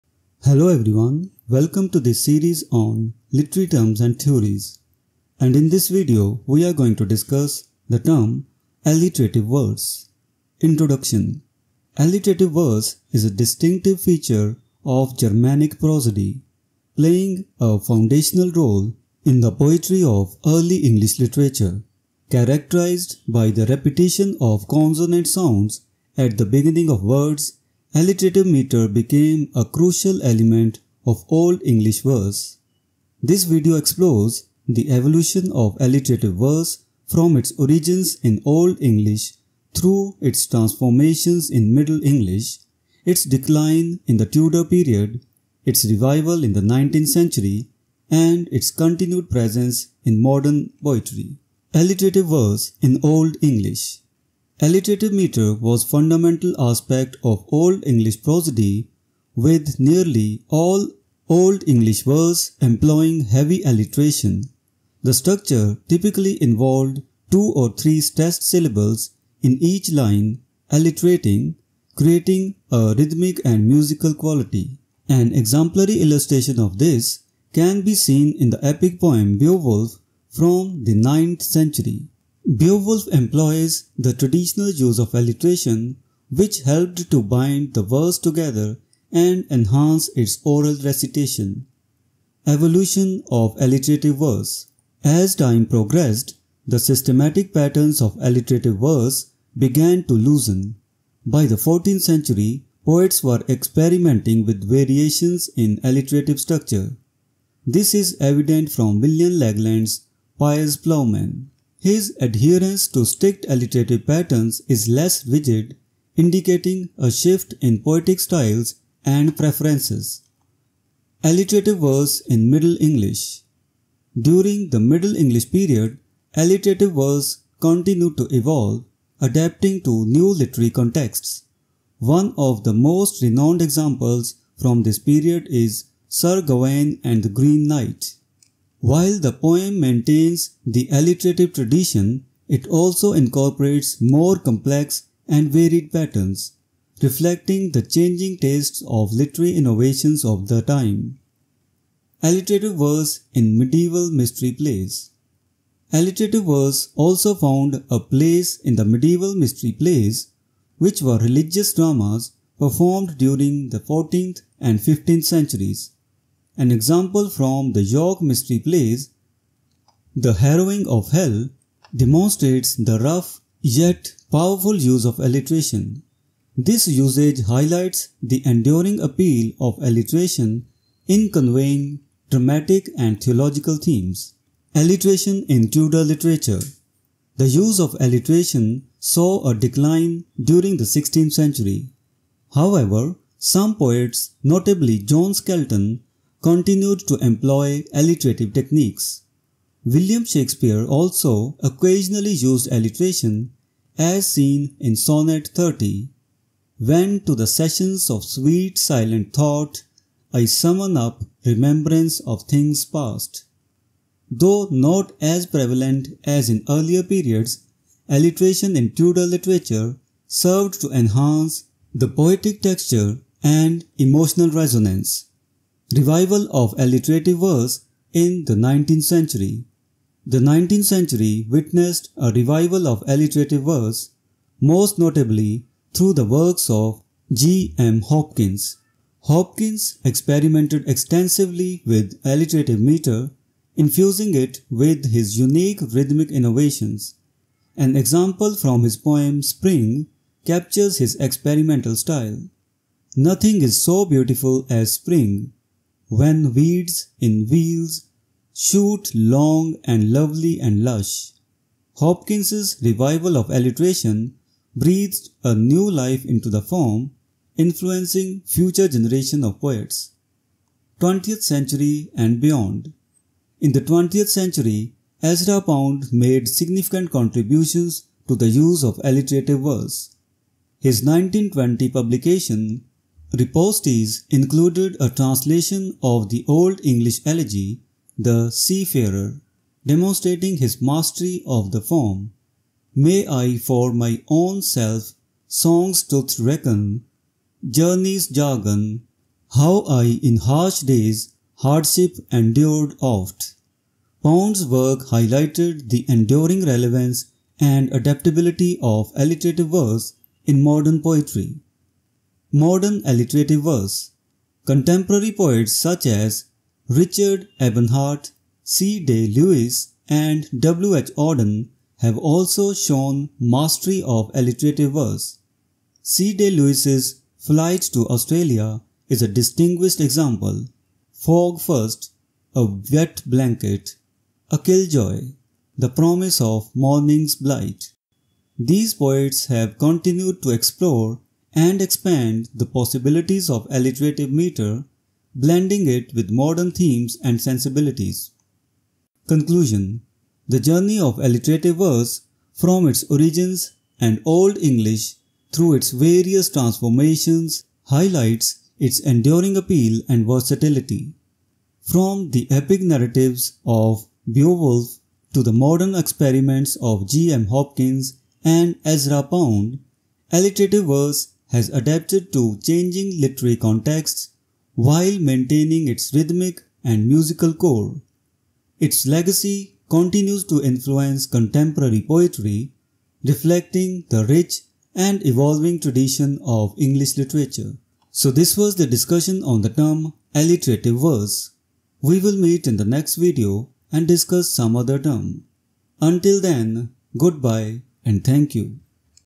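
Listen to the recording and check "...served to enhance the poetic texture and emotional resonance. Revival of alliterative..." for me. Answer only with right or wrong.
right.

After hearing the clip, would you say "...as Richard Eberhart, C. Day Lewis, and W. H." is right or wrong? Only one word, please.
right.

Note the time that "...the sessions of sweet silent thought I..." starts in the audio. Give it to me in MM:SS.
03:27.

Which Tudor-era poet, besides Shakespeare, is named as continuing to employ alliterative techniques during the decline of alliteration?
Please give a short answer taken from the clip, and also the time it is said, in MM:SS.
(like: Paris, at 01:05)
John Skelton, at 03:14.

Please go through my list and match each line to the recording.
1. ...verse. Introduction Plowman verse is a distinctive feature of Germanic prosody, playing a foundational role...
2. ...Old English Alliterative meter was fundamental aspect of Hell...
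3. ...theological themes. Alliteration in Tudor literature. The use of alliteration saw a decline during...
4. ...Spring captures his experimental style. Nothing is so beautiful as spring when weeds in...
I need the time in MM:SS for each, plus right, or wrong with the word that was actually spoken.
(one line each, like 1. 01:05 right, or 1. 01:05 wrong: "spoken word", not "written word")
1. 00:09 wrong: "Alliterative", not "Plowman"
2. 00:53 wrong: "Old", not "Hell"
3. 03:03 right
4. 04:09 right.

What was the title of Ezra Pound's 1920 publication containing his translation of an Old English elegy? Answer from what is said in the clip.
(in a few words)
Ripostes.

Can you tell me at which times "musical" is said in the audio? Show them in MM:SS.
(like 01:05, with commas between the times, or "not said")
01:13, 06:17.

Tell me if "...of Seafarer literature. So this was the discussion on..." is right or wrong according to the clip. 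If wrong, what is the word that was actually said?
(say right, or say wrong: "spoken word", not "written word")
wrong: "English", not "Seafarer".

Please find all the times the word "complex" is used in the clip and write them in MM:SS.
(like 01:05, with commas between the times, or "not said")
02:24.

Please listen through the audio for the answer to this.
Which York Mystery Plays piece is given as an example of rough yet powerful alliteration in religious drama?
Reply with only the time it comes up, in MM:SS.
02:50.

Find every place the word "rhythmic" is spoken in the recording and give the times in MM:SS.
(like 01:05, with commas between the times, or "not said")
01:12, 04:05, 06:16.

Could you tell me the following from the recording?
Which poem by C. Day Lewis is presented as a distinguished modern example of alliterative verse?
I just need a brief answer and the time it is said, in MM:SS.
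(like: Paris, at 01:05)
Flight to Australia, at 05:27.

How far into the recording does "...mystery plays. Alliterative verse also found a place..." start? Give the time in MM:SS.
02:34.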